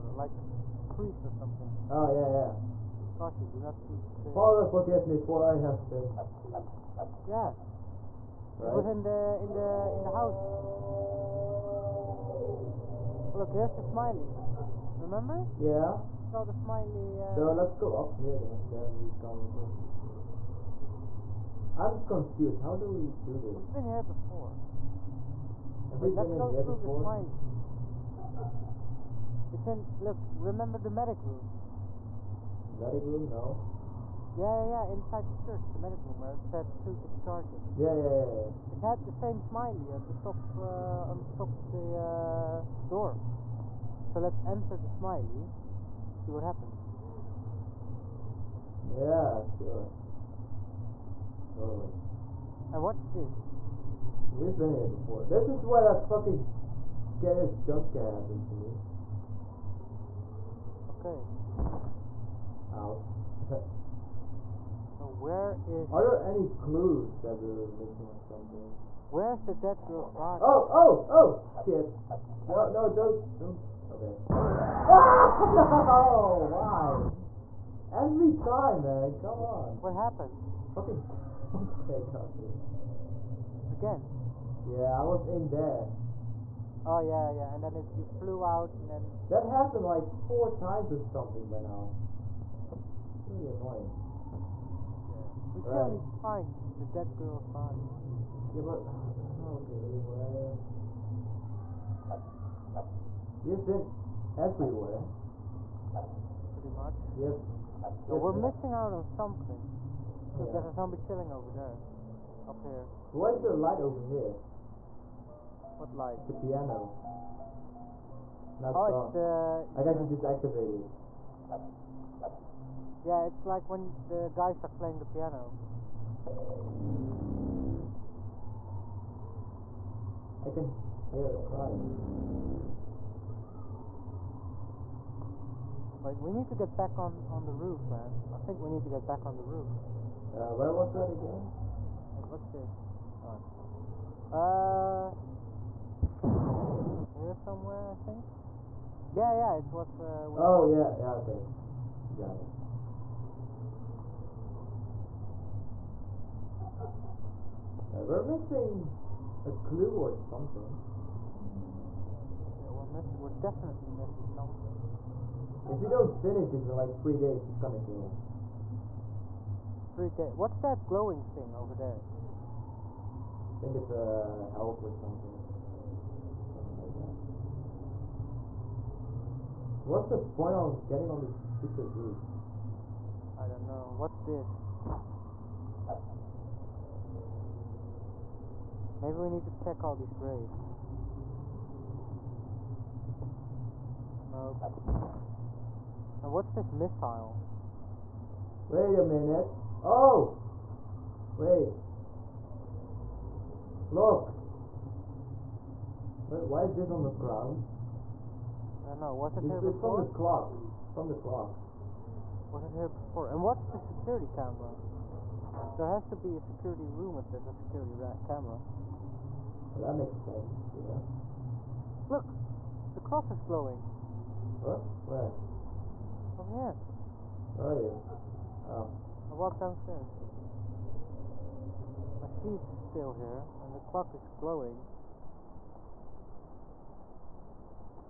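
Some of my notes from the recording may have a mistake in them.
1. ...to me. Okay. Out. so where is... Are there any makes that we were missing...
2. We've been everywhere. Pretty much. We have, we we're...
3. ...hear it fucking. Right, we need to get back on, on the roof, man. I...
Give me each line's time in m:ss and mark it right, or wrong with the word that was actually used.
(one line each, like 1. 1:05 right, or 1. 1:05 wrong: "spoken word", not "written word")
1. 0:58 wrong: "clues", not "makes"
2. 1:43 right
3. 2:11 wrong: "crying", not "fucking".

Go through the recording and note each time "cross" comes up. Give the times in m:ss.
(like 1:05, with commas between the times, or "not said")
3:42.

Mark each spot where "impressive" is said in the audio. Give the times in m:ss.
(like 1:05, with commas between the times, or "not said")
not said.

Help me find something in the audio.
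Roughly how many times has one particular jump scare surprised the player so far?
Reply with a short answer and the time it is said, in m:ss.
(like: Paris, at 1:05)
4, at 1:30.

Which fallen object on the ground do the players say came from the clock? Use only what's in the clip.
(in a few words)
Missile.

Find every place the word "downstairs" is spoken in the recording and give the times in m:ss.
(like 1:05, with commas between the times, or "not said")
3:49.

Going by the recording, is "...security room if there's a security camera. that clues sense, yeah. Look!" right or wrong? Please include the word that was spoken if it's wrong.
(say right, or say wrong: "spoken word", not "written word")
wrong: "makes", not "clues".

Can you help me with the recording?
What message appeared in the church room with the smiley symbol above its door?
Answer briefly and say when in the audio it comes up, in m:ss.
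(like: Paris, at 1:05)
Suit is charging, at 0:36.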